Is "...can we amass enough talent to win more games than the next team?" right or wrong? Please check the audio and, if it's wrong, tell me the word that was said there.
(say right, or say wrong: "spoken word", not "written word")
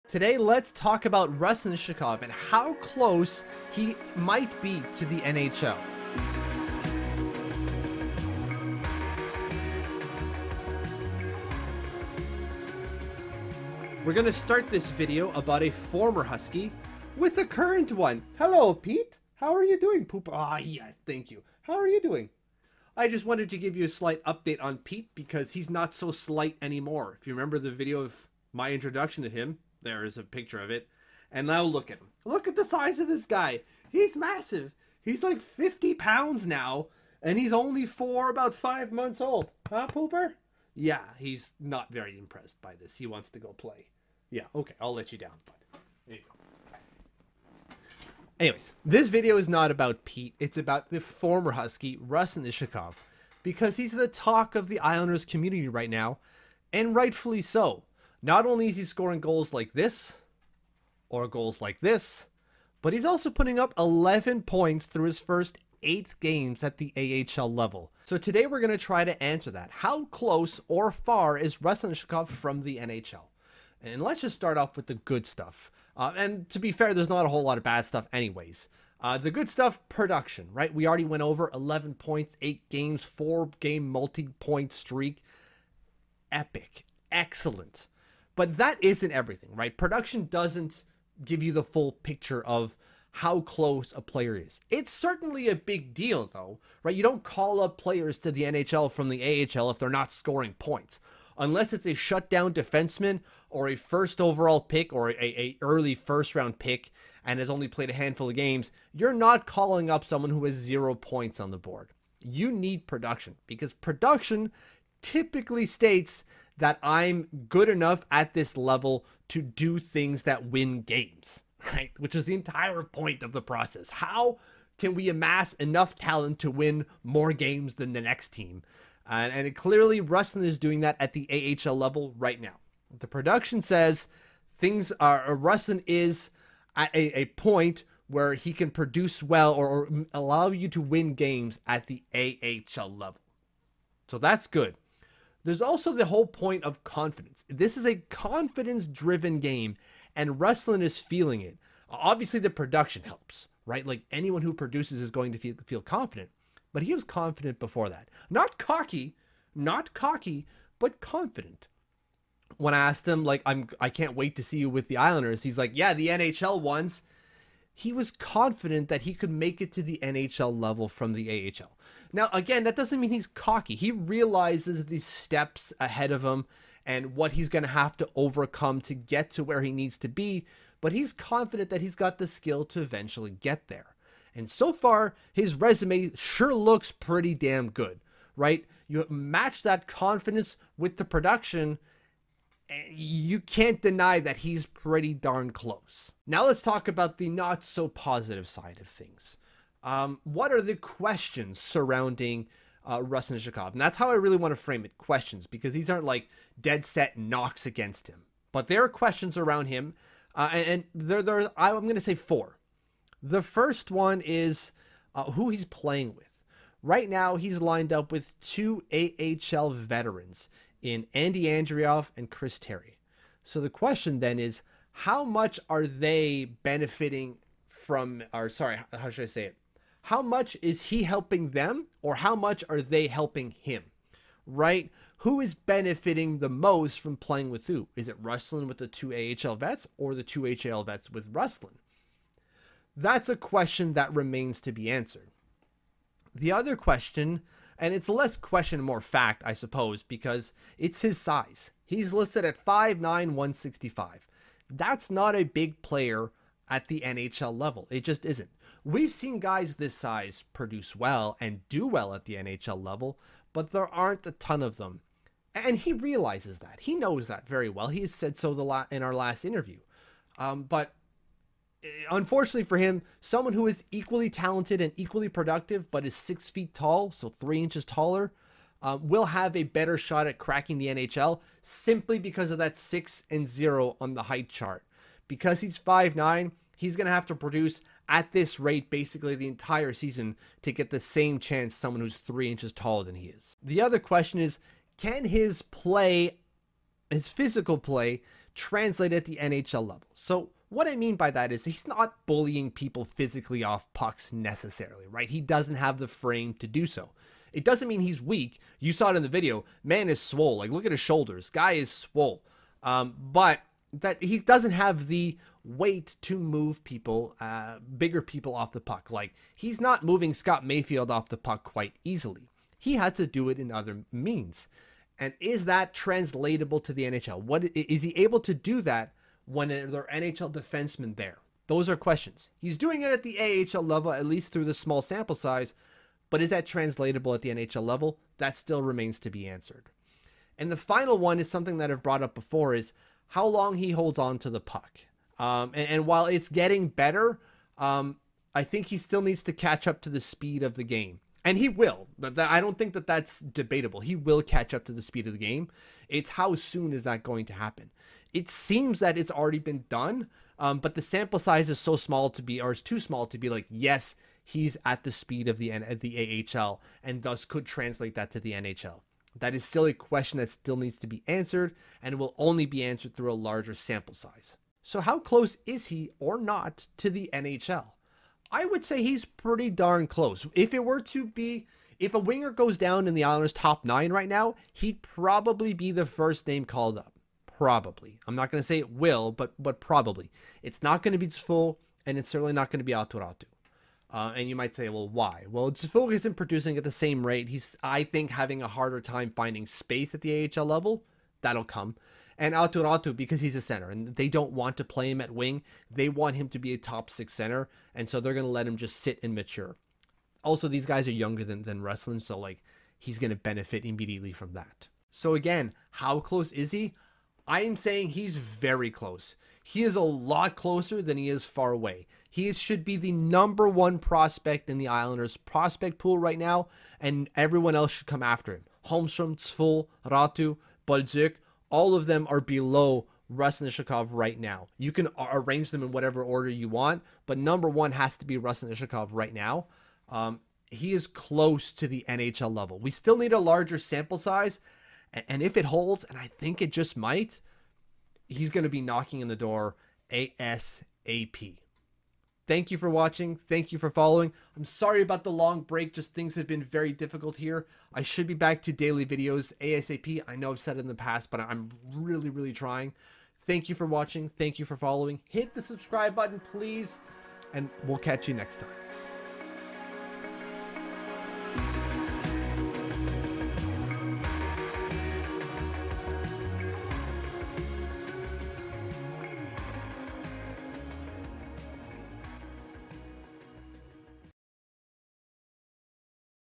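right.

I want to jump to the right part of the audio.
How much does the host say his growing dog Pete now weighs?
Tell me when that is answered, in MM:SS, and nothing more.
00:35.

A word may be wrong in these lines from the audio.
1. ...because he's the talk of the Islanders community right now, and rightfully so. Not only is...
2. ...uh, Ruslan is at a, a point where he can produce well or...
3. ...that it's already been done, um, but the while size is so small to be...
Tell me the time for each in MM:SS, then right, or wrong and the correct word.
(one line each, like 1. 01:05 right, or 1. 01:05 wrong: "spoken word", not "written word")
1. 00:53 right
2. 02:15 right
3. 05:58 wrong: "sample", not "while".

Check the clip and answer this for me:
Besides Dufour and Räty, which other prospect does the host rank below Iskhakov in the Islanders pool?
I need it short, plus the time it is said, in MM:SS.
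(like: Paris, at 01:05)
Holmstrom, at 07:08.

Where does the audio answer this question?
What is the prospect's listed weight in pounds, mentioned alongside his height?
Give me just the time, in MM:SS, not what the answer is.
04:13.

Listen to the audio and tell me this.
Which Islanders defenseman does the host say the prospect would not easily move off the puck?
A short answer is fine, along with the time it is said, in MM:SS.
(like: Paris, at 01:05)
Scott Mayfield, at 05:20.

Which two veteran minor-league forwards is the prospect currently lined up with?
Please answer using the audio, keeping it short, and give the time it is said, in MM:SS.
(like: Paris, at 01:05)
Andy Andreoff and Chris Terry, at 03:41.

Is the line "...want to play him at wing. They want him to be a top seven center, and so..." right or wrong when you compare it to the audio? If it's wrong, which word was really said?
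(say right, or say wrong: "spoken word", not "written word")
wrong: "six", not "seven".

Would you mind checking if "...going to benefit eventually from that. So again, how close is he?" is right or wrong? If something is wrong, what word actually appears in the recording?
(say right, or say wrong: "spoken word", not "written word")
wrong: "immediately", not "eventually".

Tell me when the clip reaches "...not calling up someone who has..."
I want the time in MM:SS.
01:49.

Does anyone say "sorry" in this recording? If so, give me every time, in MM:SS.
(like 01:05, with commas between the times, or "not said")
03:48, 07:34.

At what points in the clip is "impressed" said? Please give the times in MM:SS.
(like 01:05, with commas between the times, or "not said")
00:42.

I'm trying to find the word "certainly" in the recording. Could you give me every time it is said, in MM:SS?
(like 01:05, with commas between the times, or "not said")
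01:34, 06:32.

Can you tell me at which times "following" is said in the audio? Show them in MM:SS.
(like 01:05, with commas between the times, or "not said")
07:33, 07:44.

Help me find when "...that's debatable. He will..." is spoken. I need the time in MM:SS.
05:53.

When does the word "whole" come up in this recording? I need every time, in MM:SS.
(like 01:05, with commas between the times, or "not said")
01:17, 02:26.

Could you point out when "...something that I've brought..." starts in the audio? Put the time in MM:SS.
05:41.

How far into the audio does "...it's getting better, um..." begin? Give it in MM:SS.
05:46.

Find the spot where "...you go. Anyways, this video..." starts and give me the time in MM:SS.
00:46.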